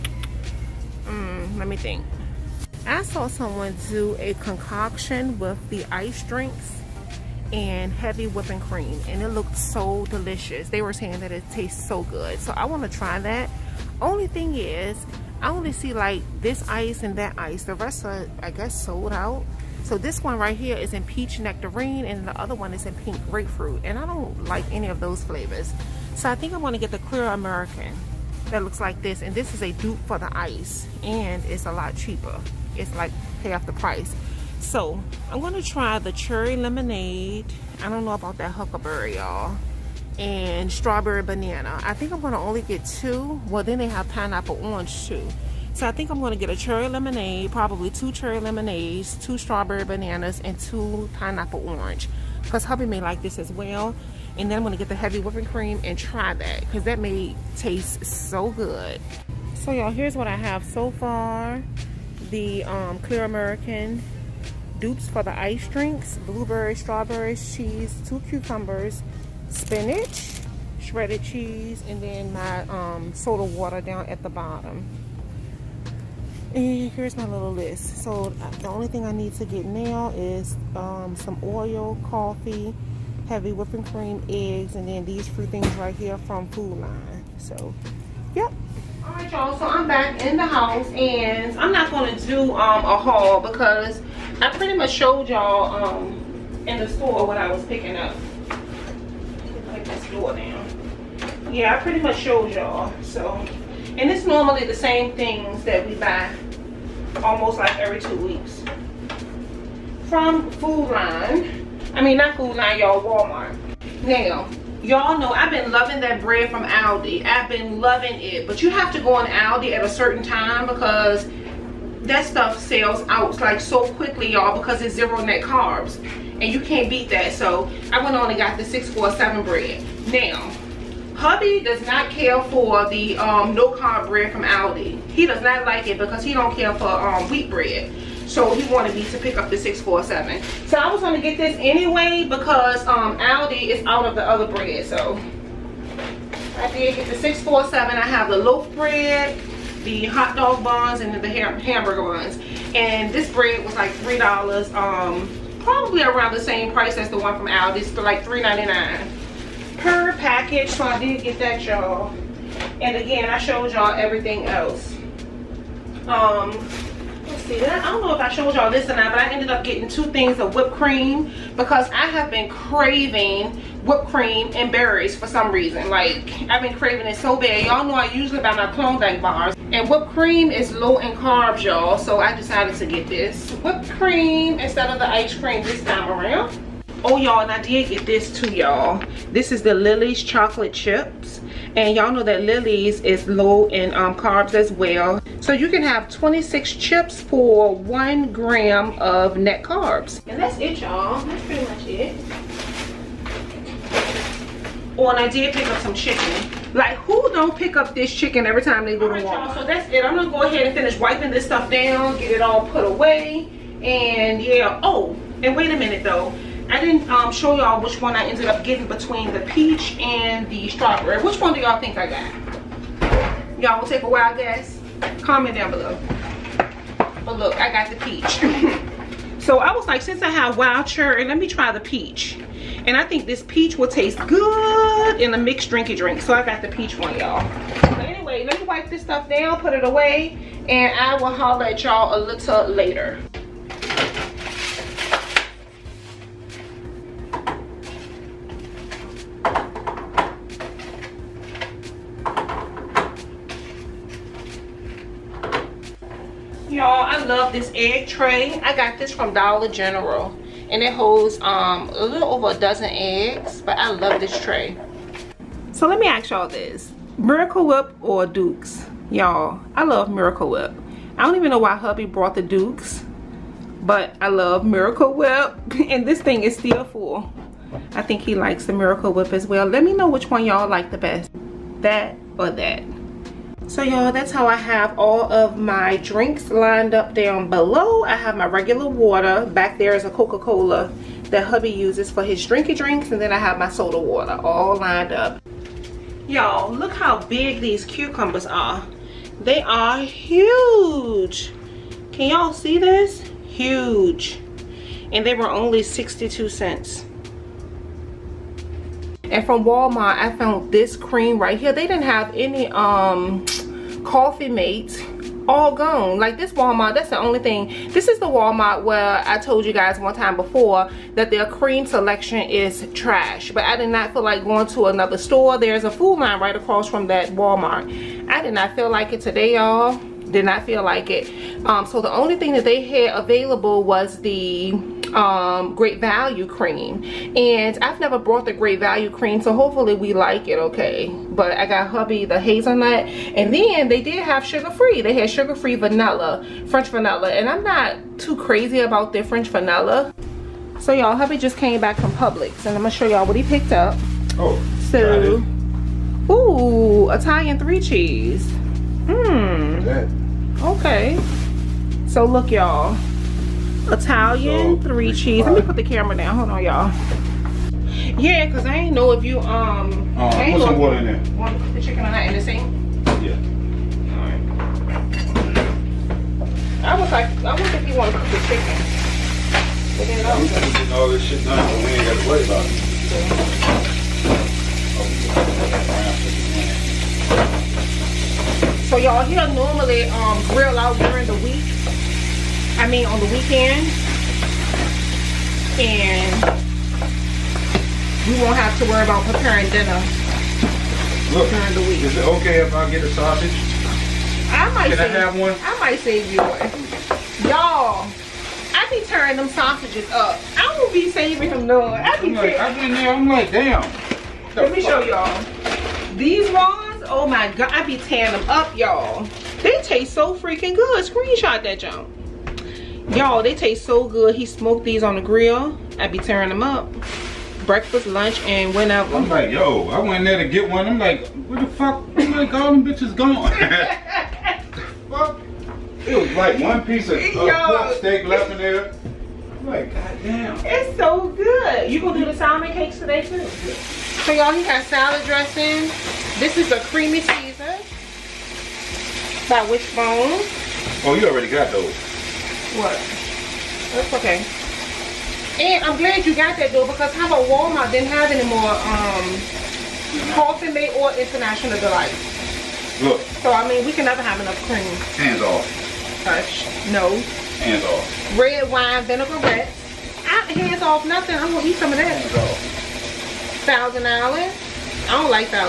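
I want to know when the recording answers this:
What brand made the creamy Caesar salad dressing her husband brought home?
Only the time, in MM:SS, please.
07:29.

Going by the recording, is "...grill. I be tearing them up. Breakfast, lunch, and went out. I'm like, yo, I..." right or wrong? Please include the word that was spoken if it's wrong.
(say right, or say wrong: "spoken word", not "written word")
right.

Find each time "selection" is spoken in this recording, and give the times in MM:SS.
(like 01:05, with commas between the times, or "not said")
05:21.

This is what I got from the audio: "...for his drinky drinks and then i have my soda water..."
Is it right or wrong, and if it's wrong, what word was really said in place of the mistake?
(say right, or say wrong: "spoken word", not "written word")
right.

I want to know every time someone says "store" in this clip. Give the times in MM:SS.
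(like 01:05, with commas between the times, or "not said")
01:36, 05:25.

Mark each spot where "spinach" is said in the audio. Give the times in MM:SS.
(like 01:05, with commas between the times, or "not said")
01:09.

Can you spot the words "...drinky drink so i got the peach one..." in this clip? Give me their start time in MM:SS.
03:55.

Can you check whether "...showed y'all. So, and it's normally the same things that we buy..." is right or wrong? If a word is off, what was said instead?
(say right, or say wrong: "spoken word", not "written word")
right.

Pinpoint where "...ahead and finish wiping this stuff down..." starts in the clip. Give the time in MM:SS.
03:30.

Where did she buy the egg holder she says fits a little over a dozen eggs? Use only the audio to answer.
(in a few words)
Dollar General.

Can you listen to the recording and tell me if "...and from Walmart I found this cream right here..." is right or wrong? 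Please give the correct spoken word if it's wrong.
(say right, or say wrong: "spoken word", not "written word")
right.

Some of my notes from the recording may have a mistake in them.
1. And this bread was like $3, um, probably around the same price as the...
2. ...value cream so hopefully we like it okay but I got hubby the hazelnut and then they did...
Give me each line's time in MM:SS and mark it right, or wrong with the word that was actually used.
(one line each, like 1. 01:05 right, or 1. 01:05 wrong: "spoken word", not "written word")
1. 02:32 right
2. 05:38 right.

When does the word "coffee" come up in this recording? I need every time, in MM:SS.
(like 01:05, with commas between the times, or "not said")
01:22, 05:14, 07:40.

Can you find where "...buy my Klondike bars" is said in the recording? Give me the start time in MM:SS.
02:58.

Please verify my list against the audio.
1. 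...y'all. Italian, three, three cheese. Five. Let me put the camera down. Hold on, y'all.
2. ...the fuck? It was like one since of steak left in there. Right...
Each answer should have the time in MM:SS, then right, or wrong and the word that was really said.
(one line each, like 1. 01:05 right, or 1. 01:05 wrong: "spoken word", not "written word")
1. 06:02 right
2. 07:13 wrong: "piece", not "since".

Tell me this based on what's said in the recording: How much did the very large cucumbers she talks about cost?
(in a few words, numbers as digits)
62 cents.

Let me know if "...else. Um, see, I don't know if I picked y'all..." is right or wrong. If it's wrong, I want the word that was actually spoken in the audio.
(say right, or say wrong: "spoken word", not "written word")
wrong: "showed", not "picked".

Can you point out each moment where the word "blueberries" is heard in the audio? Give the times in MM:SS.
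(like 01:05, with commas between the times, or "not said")
01:06.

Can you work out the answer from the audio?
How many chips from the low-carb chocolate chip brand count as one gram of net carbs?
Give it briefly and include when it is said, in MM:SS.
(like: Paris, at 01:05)
26, at 03:16.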